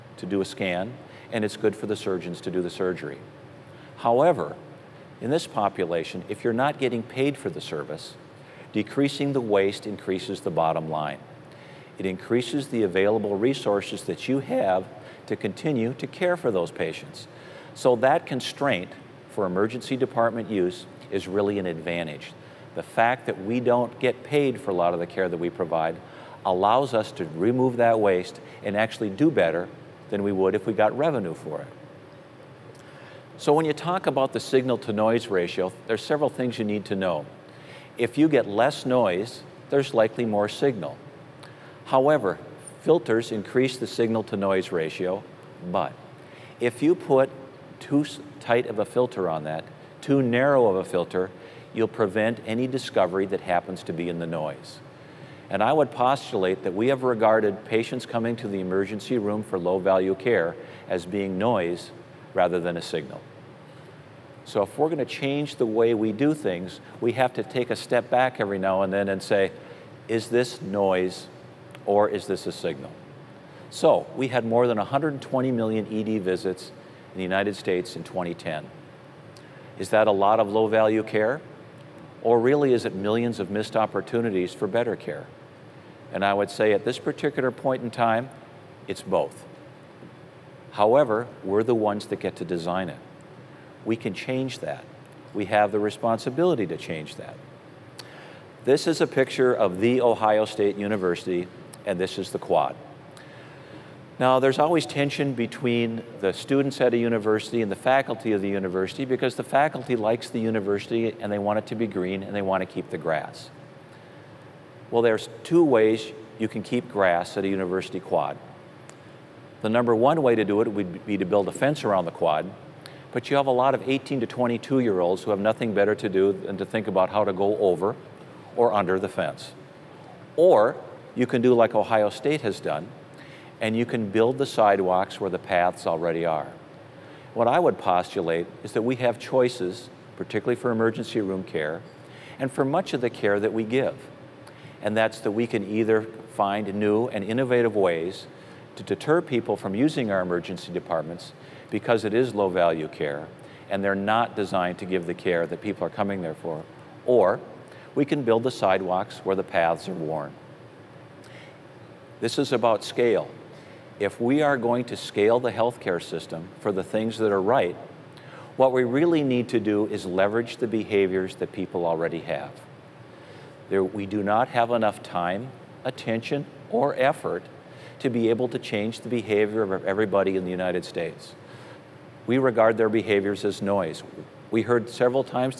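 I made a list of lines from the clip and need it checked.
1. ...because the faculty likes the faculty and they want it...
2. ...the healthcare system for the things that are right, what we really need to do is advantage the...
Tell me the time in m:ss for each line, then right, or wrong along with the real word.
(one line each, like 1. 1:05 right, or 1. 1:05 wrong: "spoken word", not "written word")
1. 1:49 wrong: "university", not "faculty"
2. 2:45 wrong: "leverage", not "advantage".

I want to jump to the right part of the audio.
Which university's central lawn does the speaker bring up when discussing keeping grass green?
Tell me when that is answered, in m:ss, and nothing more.
1:40.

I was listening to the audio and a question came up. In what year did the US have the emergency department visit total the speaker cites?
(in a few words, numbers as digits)
2010.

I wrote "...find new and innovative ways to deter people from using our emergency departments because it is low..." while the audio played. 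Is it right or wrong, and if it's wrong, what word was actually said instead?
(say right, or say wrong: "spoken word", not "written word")
right.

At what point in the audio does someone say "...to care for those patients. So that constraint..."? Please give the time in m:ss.
0:15.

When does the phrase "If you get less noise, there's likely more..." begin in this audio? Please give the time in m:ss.
0:37.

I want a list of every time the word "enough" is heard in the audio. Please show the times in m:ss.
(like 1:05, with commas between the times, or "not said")
2:54.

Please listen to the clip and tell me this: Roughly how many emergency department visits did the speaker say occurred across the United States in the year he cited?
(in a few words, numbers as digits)
more than 120 million.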